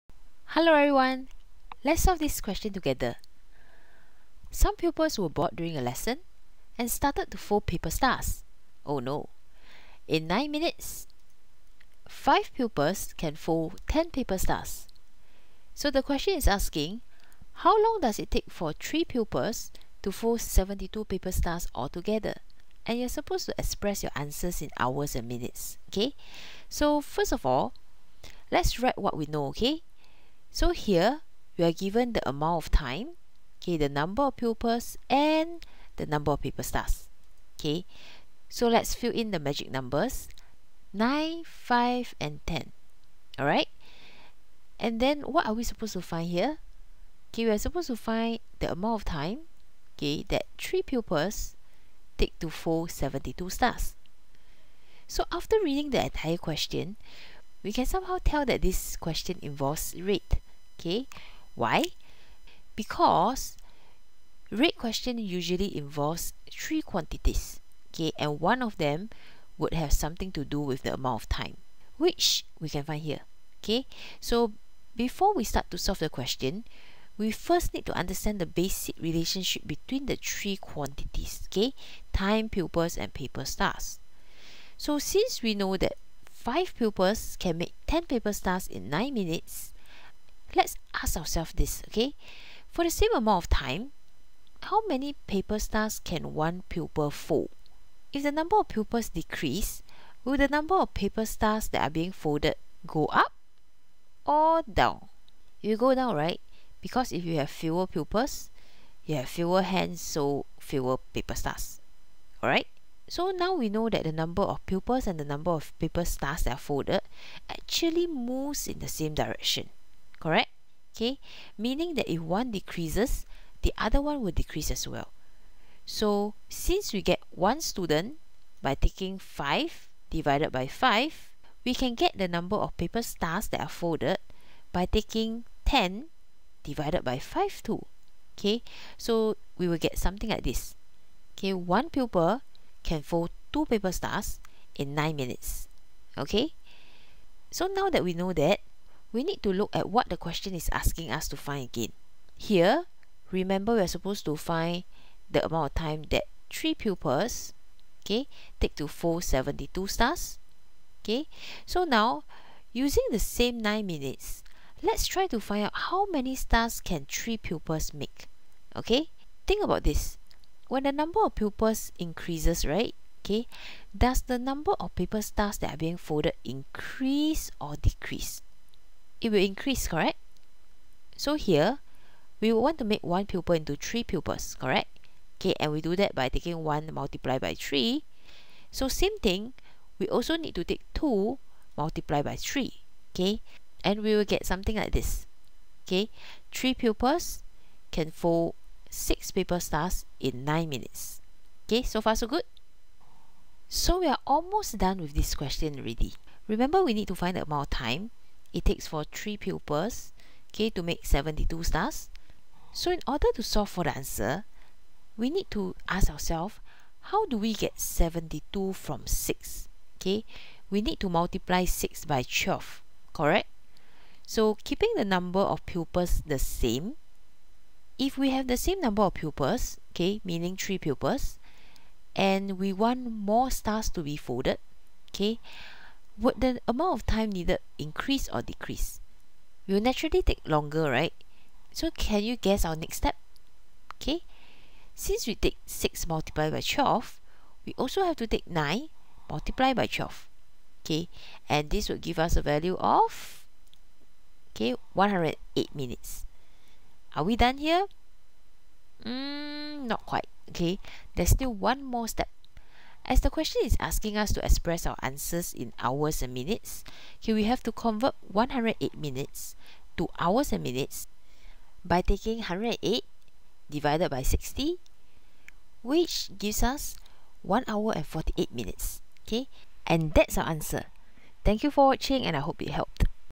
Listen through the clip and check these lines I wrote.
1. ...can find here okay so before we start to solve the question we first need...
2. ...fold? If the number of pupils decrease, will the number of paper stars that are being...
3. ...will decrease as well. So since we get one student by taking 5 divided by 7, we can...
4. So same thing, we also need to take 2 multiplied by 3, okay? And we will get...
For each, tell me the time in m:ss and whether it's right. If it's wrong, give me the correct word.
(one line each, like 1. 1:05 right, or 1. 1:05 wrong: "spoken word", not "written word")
1. 1:12 right
2. 1:37 right
3. 2:04 wrong: "5", not "7"
4. 3:08 right.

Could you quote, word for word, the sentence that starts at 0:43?
Alright, and then what are we supposed to find here?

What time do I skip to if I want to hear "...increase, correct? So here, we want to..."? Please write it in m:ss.
2:59.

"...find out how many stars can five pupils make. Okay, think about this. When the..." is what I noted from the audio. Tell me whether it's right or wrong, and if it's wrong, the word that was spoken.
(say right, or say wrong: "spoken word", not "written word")
wrong: "three", not "five".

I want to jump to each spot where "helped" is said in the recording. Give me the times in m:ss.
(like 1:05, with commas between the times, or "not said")
4:42.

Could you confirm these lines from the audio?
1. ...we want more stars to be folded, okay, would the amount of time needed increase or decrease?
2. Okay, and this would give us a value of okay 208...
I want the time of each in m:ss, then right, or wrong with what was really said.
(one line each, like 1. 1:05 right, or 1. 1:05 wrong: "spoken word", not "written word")
1. 3:52 right
2. 4:10 wrong: "108", not "208".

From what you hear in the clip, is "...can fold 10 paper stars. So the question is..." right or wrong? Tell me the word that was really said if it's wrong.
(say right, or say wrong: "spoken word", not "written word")
right.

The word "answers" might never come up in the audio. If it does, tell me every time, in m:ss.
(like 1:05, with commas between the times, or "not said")
0:24, 3:33, 4:25, 4:40.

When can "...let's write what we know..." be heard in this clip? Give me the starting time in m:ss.
0:28.